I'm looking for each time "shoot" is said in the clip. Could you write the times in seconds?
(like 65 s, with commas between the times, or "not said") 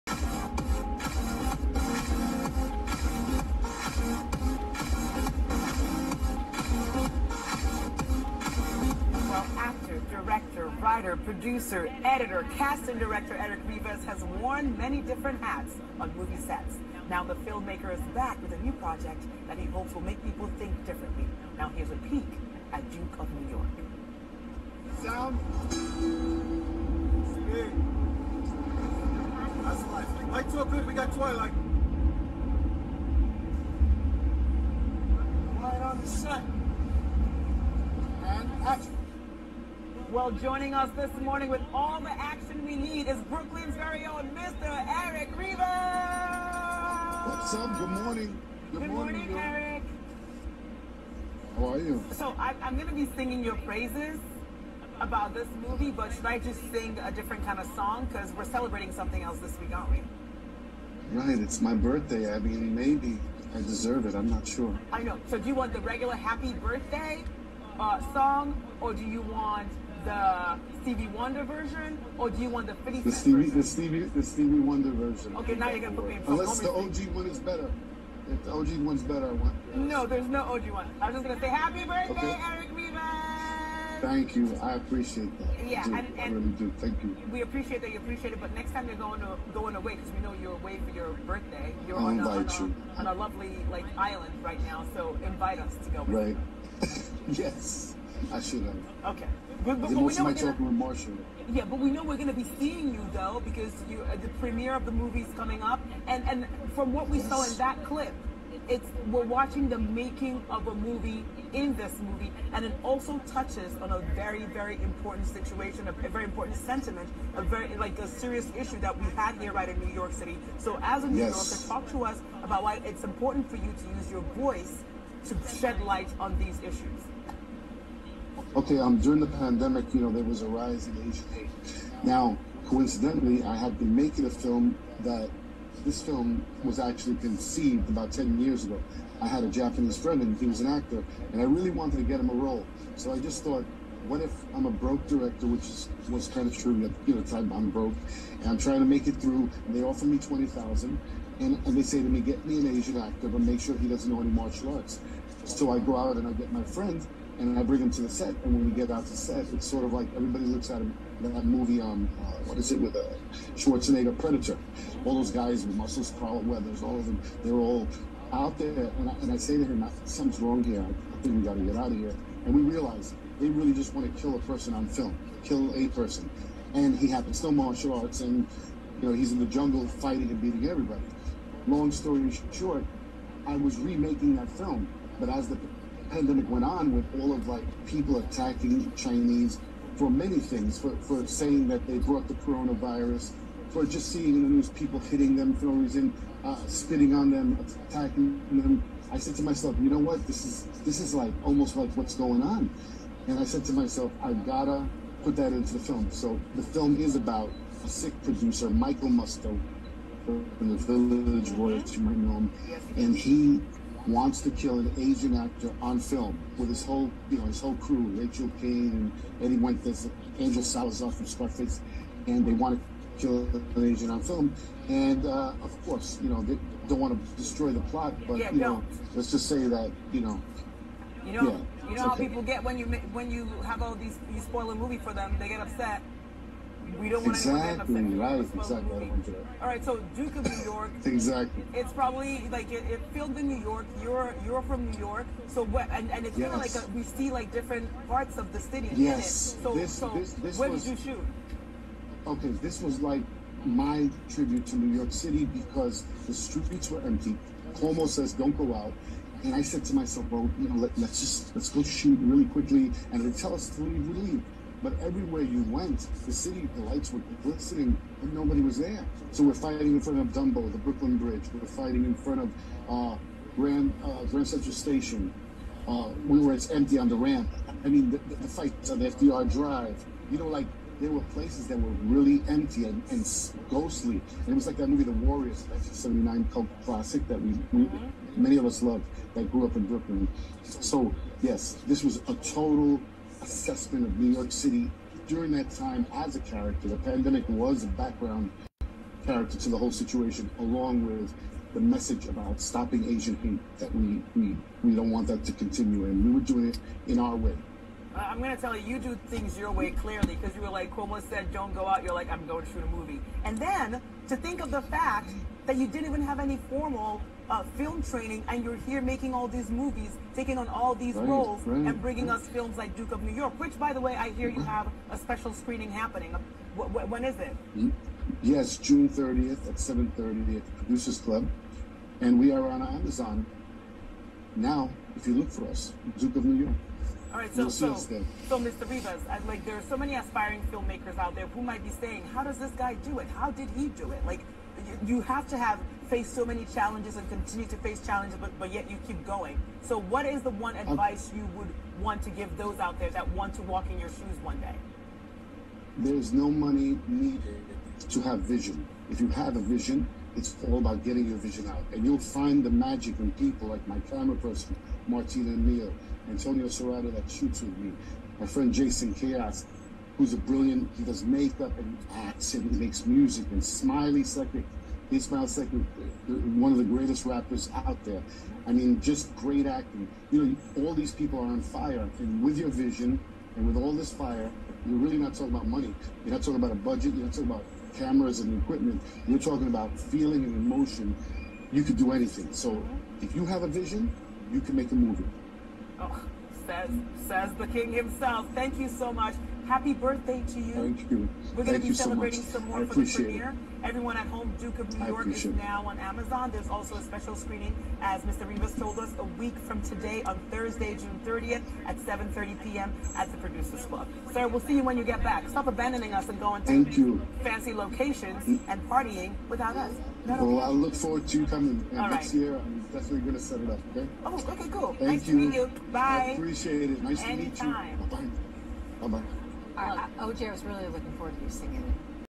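251 s, 261 s, 312 s, 367 s.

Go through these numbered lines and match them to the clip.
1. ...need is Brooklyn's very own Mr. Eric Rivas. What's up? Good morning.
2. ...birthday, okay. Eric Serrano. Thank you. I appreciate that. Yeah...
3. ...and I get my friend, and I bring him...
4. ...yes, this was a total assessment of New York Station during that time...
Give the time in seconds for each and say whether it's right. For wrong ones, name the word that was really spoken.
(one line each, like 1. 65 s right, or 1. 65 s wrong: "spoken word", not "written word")
1. 42 s right
2. 81 s wrong: "Rivas", not "Serrano"
3. 156 s right
4. 291 s wrong: "City", not "Station".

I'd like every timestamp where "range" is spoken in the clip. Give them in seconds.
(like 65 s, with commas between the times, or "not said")
not said.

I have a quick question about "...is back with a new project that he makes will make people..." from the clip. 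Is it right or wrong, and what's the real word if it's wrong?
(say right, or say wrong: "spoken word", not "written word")
wrong: "hopes", not "makes".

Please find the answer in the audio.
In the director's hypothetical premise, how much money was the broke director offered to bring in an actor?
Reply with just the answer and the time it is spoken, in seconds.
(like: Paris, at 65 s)
20,000, at 150 s.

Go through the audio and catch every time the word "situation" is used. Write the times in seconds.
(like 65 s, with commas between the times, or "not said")
115 s, 299 s.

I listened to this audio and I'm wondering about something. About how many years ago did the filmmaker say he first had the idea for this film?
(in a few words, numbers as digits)
10 years.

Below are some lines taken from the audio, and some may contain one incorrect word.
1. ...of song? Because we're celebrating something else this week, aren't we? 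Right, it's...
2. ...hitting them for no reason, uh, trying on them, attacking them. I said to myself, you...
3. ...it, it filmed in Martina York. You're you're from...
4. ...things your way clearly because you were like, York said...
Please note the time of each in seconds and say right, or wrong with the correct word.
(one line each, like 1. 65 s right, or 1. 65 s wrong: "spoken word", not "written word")
1. 57 s right
2. 194 s wrong: "spitting", not "trying"
3. 242 s wrong: "New", not "Martina"
4. 309 s wrong: "Cuomo", not "York".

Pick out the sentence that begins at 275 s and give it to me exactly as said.
Uh, we were it's empty on the ramp.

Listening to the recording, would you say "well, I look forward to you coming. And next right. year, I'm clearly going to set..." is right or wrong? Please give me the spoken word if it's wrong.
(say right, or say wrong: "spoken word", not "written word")
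wrong: "definitely", not "clearly".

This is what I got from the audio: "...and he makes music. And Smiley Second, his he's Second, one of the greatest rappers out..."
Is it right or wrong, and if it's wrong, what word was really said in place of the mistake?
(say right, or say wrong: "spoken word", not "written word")
right.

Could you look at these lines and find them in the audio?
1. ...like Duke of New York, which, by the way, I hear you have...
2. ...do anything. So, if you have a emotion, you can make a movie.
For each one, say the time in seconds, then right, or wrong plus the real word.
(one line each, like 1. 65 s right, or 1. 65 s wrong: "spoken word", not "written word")
1. 322 s right
2. 391 s wrong: "vision", not "emotion".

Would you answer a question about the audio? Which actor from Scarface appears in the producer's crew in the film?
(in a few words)
Angel Salazar.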